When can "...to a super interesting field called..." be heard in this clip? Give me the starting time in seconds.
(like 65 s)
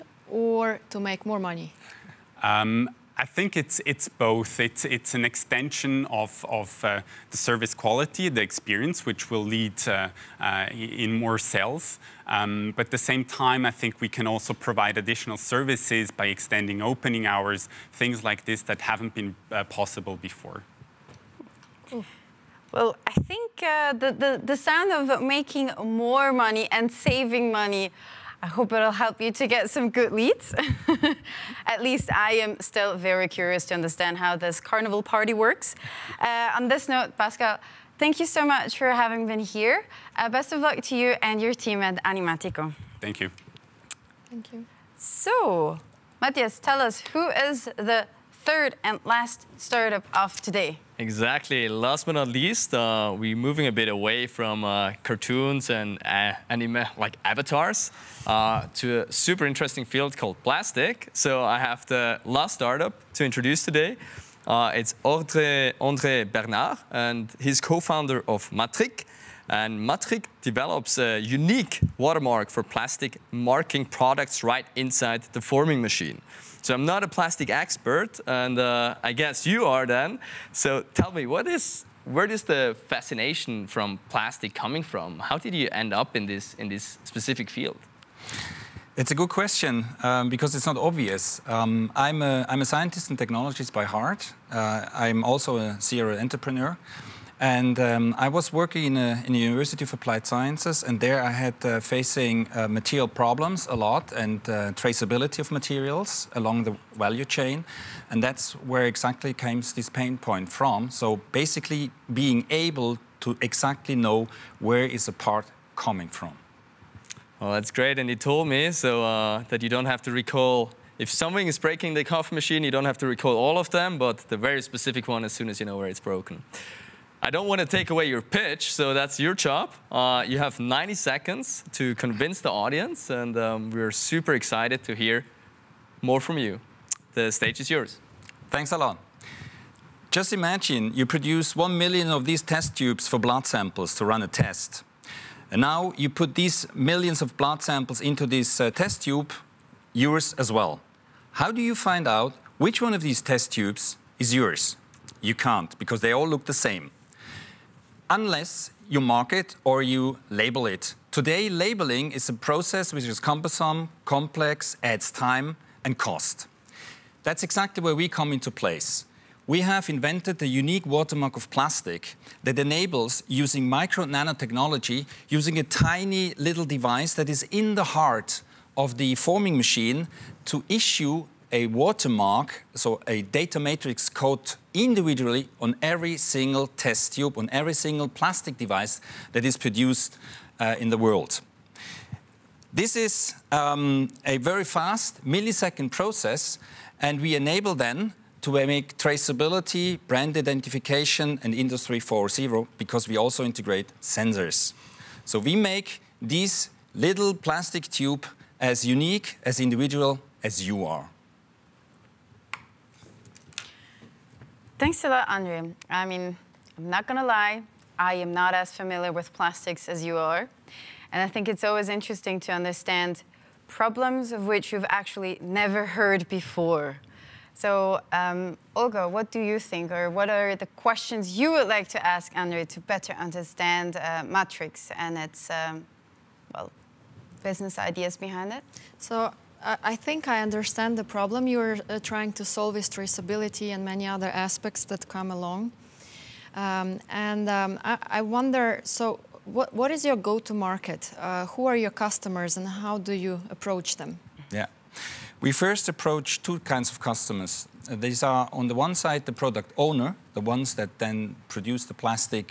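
58 s.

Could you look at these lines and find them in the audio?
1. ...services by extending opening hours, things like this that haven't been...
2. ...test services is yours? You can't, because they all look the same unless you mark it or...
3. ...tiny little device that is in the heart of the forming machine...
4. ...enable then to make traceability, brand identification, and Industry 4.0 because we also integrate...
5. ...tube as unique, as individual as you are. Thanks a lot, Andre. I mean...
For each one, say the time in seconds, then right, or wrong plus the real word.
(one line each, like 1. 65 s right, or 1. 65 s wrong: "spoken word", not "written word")
1. 15 s right
2. 153 s wrong: "tubes", not "services"
3. 175 s right
4. 197 s right
5. 207 s right.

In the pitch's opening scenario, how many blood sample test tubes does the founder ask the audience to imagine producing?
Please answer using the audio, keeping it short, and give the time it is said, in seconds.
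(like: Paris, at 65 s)
1 million, at 141 s.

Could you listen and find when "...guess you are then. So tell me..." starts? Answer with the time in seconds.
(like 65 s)
79 s.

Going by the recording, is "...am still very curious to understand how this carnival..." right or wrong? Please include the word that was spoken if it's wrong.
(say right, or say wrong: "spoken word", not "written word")
right.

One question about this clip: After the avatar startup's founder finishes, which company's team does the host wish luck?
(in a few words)
Animatico.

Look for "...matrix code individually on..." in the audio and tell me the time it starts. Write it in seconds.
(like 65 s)
183 s.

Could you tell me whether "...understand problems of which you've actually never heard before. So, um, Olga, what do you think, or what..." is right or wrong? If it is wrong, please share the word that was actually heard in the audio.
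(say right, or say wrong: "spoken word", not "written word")
right.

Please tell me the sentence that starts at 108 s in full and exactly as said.
And that's where exactly comes this pain point from.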